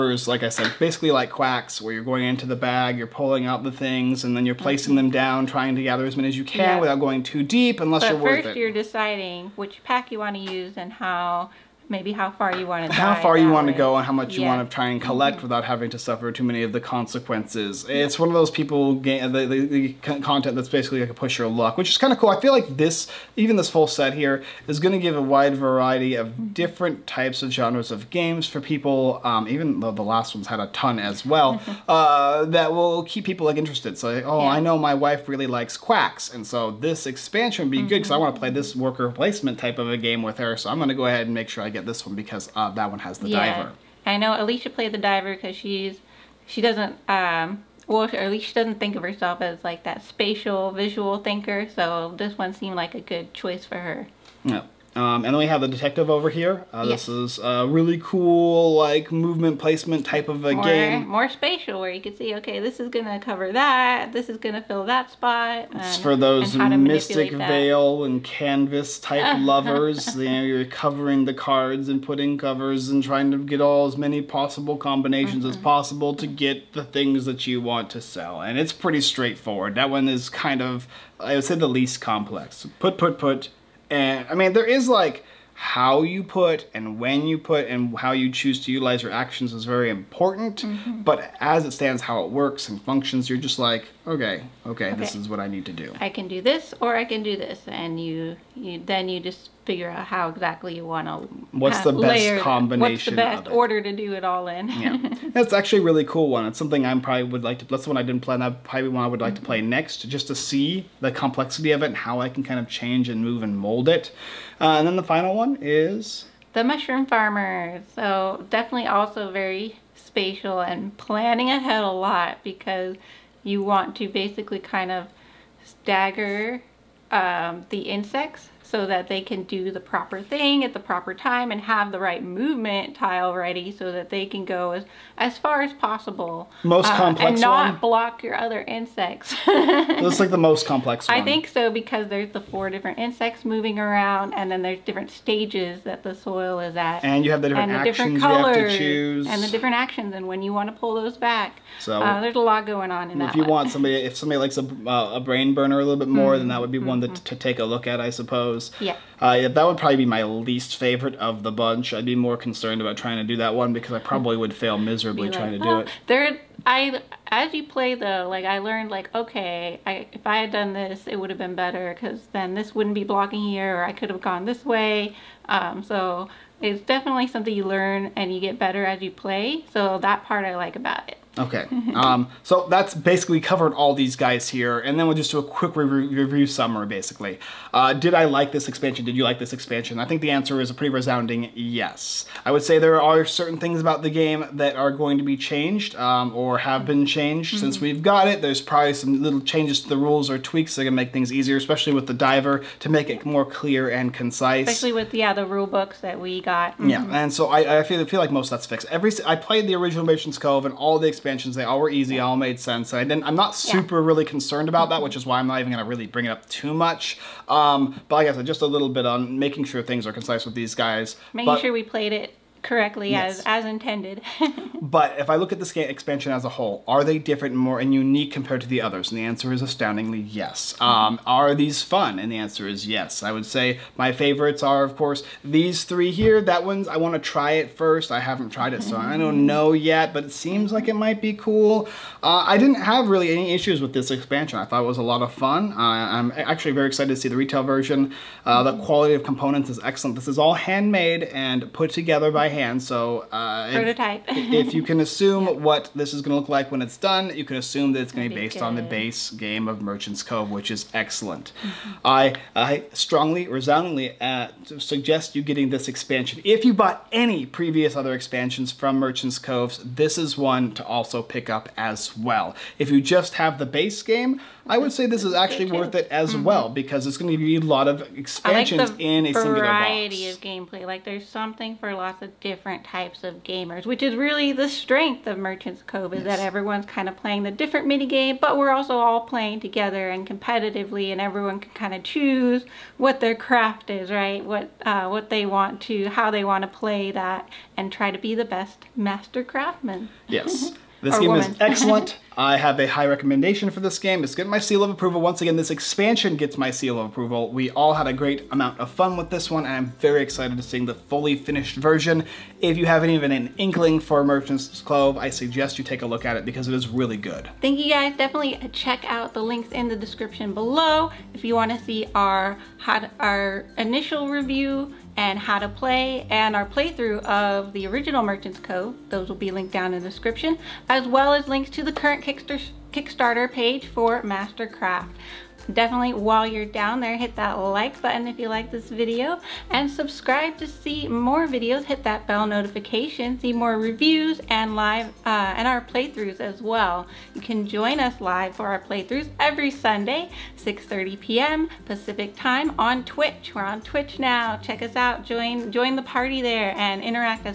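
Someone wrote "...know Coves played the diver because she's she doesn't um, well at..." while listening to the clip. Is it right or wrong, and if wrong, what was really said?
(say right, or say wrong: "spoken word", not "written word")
wrong: "Alicia", not "Coves".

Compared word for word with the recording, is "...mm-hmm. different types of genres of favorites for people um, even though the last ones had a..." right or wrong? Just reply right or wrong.
wrong.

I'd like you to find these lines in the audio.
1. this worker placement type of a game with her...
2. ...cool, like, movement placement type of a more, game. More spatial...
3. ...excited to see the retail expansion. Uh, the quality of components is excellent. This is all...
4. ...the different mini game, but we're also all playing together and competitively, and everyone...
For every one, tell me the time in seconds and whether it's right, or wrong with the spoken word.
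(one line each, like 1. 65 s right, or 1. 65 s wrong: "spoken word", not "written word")
1. 38 s right
2. 58 s right
3. 246 s wrong: "version", not "expansion"
4. 287 s right.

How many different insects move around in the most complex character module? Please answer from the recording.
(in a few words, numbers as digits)
4.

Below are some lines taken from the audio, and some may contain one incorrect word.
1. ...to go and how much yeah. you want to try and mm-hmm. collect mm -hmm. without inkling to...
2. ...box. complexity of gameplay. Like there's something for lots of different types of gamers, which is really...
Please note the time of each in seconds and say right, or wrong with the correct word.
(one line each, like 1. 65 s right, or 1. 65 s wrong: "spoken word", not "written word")
1. 13 s wrong: "having", not "inkling"
2. 279 s wrong: "variety", not "complexity".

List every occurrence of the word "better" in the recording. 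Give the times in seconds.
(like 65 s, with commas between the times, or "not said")
171 s, 178 s.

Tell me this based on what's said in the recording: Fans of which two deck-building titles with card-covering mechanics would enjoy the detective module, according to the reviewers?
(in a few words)
Mystic Vale and Canvas.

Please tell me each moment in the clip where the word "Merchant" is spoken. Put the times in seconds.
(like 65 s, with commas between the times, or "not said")
210 s, 259 s, 268 s, 285 s, 314 s, 328 s.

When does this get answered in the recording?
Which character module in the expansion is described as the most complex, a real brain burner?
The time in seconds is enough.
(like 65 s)
116 s.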